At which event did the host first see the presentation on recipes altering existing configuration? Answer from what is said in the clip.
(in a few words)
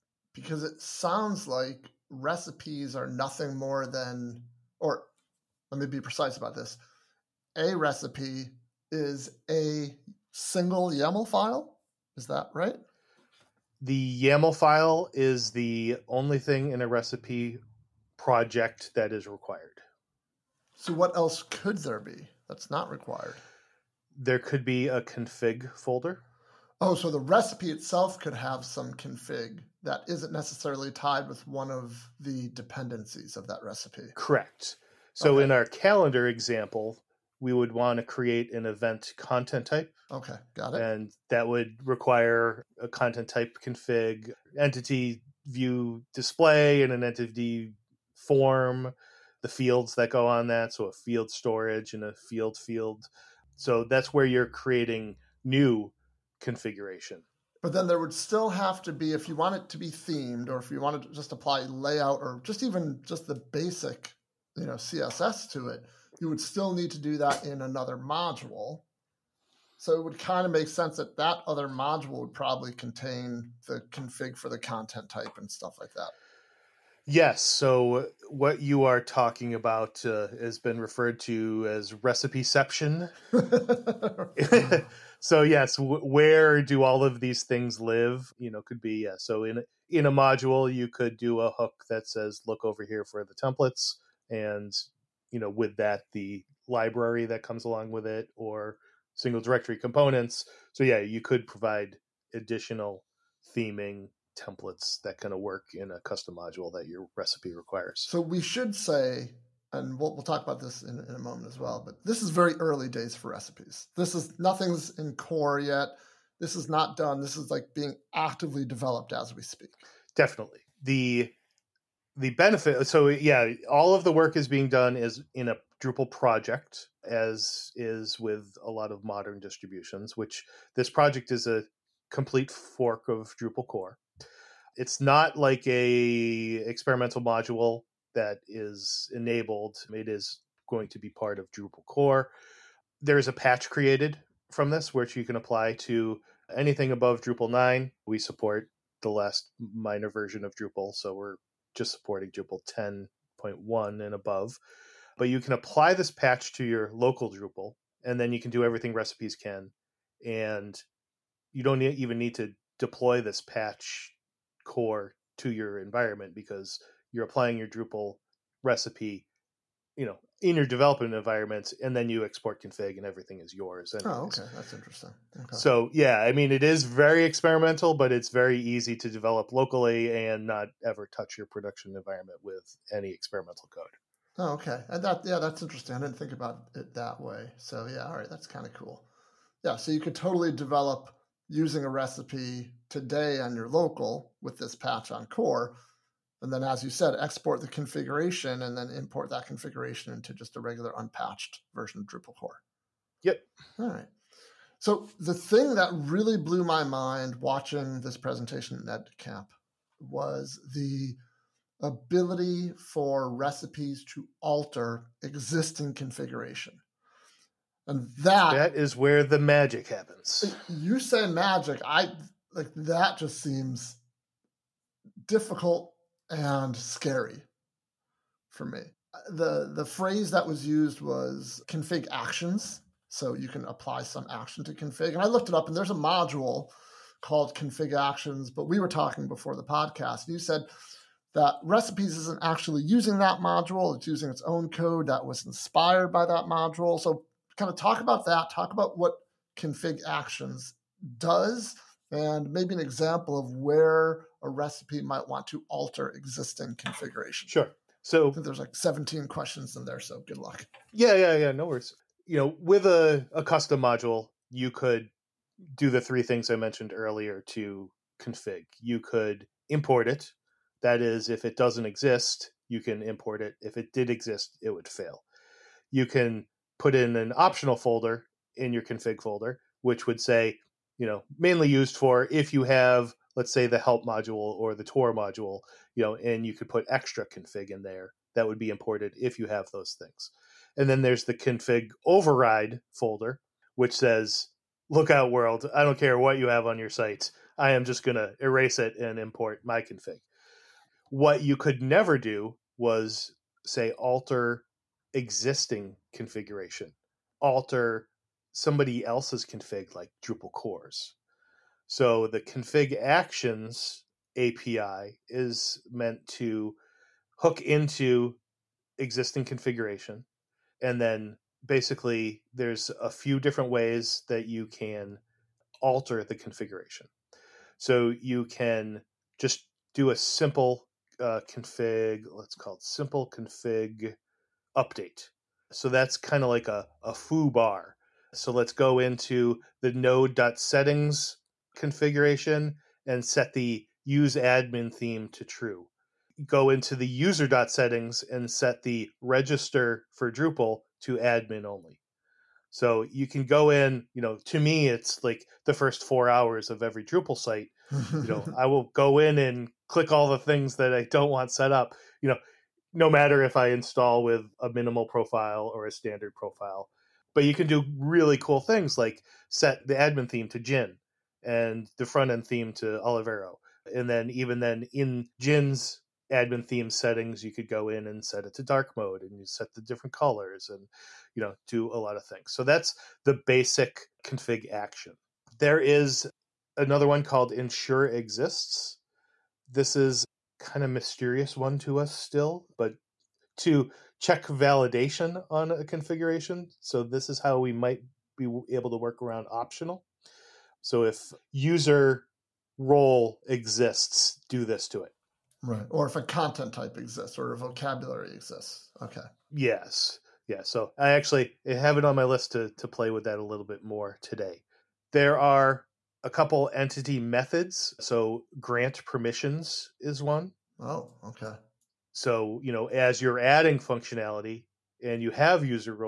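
NEDCamp.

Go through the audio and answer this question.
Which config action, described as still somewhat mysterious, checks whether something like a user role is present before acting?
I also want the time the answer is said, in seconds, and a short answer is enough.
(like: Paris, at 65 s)
Ensure exists, at 387 s.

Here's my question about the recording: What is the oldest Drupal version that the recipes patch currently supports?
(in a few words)
Drupal 10.1.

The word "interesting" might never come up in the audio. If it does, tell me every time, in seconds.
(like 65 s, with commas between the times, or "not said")
174 s, 185 s.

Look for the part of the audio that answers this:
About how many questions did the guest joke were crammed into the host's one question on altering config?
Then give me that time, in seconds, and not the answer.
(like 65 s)
258 s.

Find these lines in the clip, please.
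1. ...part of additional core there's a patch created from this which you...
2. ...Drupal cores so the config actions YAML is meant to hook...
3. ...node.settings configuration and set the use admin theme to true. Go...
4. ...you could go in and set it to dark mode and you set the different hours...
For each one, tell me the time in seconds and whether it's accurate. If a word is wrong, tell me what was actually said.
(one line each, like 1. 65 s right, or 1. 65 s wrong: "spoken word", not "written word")
1. 141 s wrong: "drupal", not "additional"
2. 310 s wrong: "API", not "YAML"
3. 339 s right
4. 377 s wrong: "colors", not "hours".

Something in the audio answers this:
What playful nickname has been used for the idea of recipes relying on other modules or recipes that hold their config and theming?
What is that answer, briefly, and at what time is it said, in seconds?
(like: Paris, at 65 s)
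Recipeception, at 81 s.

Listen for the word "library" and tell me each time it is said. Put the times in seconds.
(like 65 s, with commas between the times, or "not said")
96 s.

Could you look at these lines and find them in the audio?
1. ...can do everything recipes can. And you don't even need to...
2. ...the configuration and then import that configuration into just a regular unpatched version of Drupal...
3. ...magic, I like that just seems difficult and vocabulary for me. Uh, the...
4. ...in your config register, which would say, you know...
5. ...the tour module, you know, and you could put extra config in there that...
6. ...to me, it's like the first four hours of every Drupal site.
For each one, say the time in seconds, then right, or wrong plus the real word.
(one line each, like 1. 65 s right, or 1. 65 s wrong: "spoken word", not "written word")
1. 158 s right
2. 197 s right
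3. 221 s wrong: "scary", not "vocabulary"
4. 278 s wrong: "folder", not "register"
5. 284 s right
6. 354 s right.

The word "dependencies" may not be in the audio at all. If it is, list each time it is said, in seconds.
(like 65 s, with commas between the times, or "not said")
32 s.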